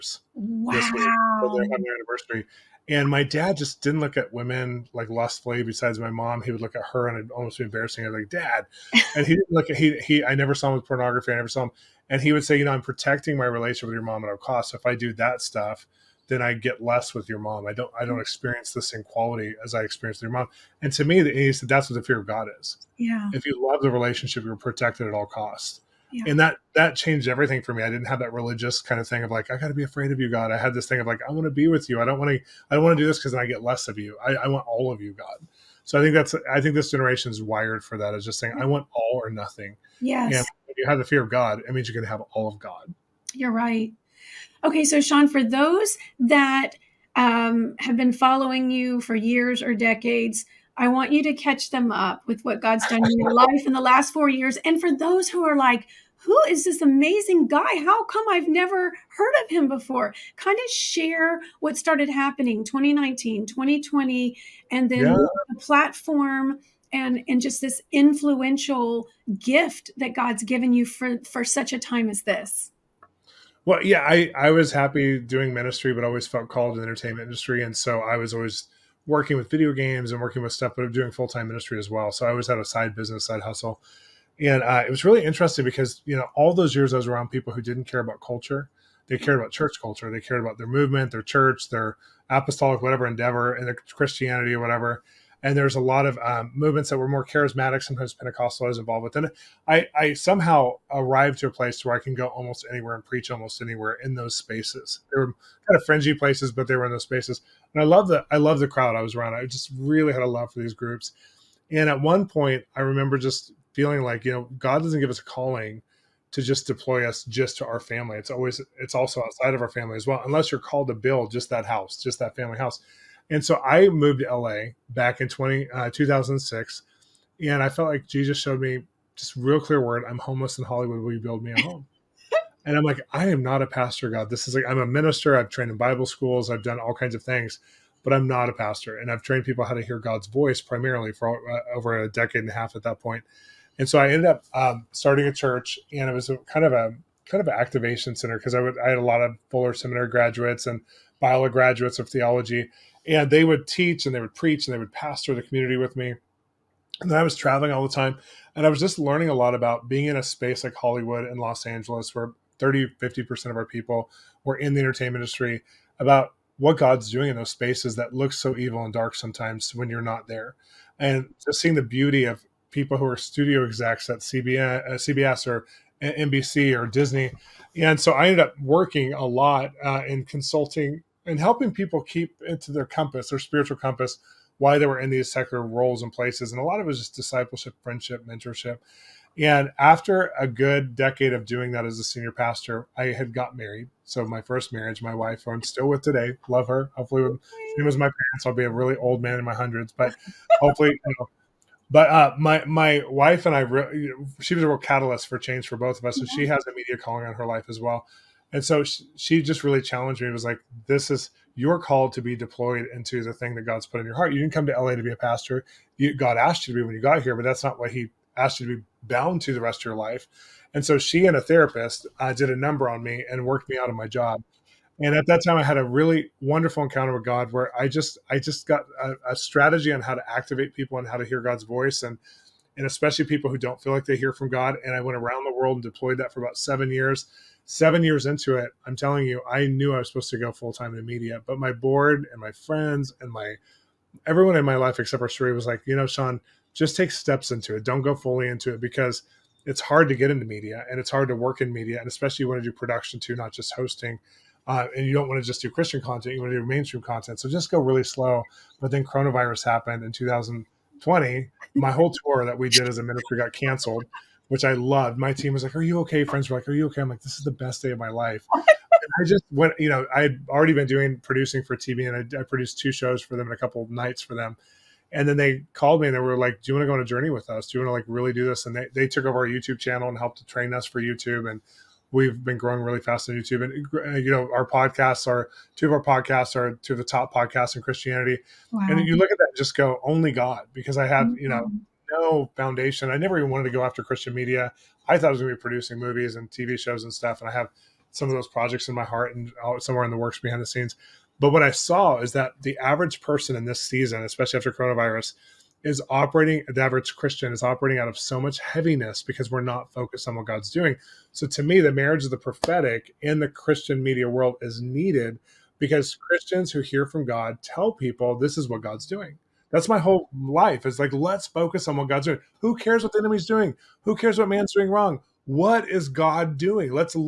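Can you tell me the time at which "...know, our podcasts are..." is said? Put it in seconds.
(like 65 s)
284 s.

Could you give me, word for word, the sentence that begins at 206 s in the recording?
has a media calling on her life as well.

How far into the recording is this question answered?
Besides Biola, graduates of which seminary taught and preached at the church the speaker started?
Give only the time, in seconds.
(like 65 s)
149 s.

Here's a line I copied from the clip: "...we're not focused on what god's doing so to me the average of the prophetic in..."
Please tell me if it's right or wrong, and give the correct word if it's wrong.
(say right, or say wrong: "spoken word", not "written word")
wrong: "marriage", not "average".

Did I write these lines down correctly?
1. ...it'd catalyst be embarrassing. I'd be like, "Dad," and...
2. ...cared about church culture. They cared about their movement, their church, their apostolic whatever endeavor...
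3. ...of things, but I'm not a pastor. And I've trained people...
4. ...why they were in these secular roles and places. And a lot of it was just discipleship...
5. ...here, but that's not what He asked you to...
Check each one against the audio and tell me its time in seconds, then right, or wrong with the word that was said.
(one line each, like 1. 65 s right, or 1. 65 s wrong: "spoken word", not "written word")
1. 7 s wrong: "almost", not "catalyst"
2. 89 s right
3. 137 s right
4. 184 s right
5. 217 s right.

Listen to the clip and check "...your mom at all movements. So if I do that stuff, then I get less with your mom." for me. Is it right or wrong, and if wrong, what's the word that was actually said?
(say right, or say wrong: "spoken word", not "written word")
wrong: "costs", not "movements".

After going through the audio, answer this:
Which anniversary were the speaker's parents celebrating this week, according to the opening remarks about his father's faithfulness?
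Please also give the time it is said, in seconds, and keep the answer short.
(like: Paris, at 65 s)
100th, at 1 s.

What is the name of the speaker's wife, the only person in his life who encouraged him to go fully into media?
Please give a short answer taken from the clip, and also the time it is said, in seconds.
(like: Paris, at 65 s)
Sheree, at 245 s.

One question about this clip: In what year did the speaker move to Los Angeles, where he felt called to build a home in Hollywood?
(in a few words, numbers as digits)
2006.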